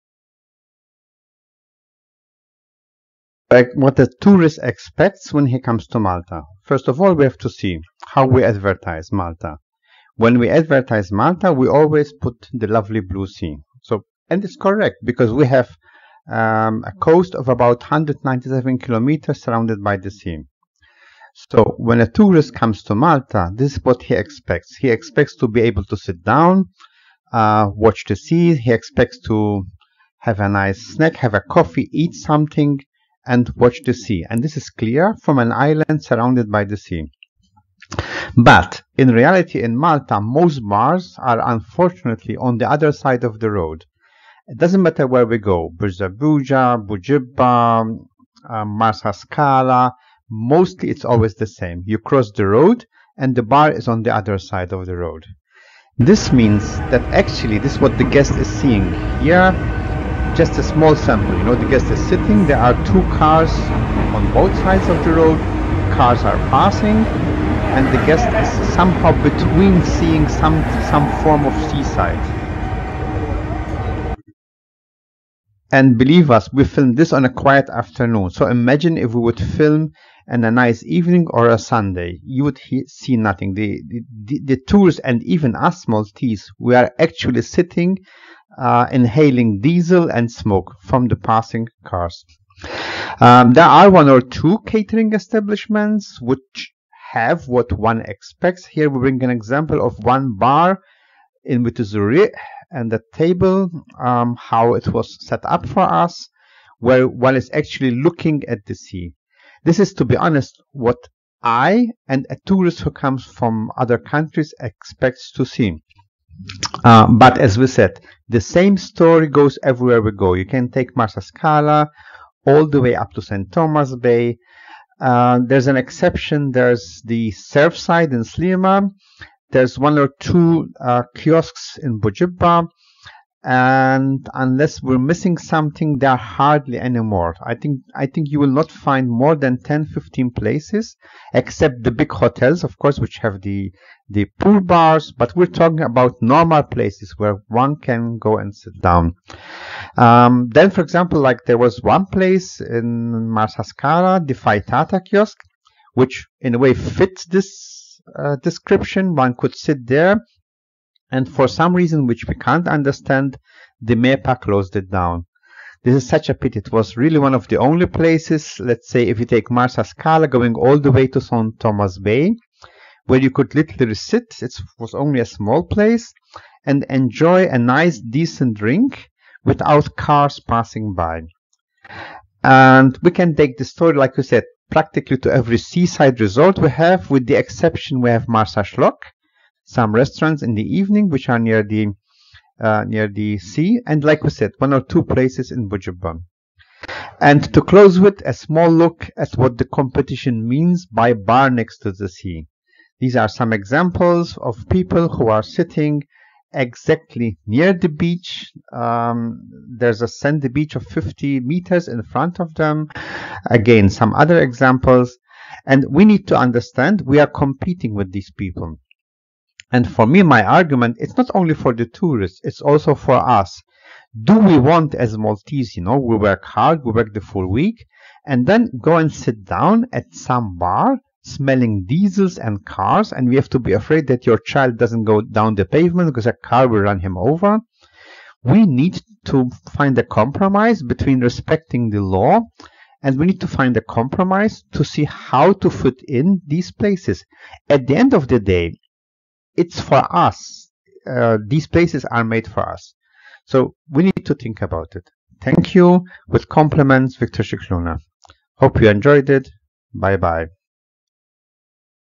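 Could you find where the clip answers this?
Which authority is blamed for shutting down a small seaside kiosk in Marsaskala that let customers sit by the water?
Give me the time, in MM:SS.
02:43.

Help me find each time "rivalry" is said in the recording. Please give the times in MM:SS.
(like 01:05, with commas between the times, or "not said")
not said.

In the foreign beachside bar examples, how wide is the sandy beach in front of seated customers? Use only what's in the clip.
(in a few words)
50 meters.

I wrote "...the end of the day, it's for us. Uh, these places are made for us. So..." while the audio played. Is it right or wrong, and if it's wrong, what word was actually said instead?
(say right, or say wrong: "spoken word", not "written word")
right.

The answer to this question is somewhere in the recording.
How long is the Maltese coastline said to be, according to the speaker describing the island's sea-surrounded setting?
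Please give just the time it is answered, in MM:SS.
00:17.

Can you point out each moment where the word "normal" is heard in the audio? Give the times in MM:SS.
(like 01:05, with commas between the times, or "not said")
02:26.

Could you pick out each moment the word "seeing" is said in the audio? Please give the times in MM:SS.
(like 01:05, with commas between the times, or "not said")
00:58, 01:09.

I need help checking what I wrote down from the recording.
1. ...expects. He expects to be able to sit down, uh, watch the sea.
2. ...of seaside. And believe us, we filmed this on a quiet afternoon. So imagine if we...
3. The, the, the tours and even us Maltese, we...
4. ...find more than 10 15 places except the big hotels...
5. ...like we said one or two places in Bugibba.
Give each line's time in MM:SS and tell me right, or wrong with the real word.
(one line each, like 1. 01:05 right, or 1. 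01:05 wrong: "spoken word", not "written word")
1. 00:24 right
2. 01:11 right
3. 01:23 right
4. 02:18 right
5. 03:14 right.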